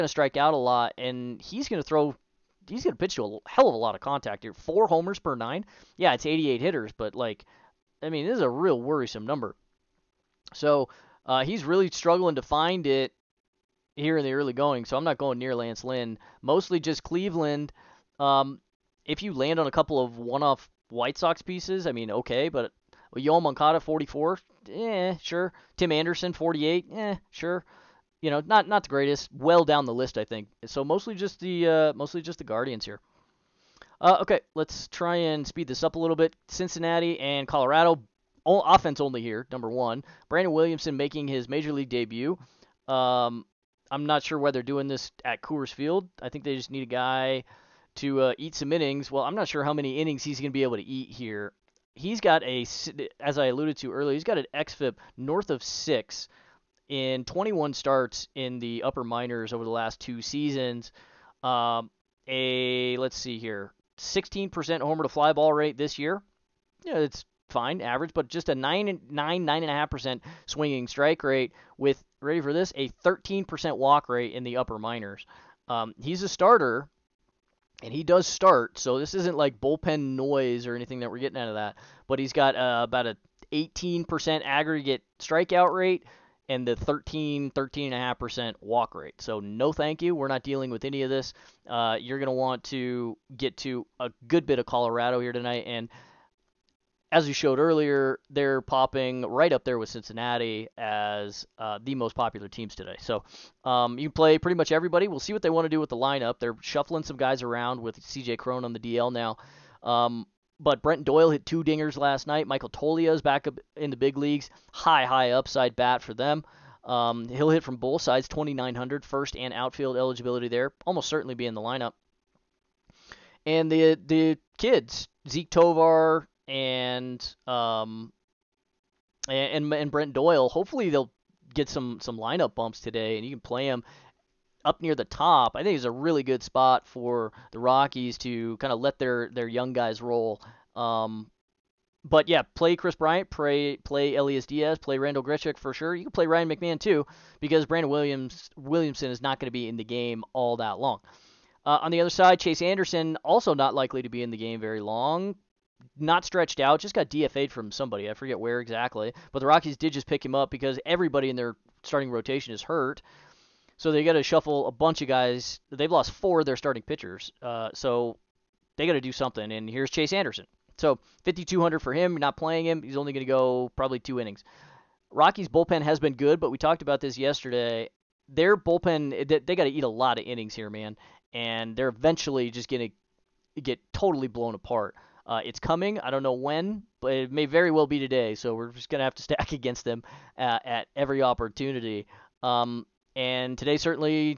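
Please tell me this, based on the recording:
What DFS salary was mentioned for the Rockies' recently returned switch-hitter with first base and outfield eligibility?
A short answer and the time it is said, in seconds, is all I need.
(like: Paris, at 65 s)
2,900, at 118 s.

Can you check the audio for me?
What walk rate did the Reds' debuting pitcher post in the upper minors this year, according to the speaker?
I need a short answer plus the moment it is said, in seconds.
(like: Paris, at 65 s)
13%, at 72 s.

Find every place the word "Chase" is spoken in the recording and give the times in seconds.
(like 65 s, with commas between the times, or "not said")
152 s, 169 s.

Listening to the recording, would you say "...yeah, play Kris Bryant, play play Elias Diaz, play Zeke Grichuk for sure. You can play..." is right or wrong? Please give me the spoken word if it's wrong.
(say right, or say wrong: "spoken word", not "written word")
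wrong: "Randall", not "Zeke".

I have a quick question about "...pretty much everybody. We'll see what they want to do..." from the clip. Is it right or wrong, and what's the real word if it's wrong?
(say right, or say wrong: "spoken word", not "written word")
right.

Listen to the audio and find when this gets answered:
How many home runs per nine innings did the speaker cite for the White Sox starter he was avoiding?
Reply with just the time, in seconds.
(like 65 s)
4 s.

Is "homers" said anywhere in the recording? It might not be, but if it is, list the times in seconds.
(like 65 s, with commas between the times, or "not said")
4 s, 64 s.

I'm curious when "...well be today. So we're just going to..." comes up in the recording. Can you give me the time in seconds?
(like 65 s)
187 s.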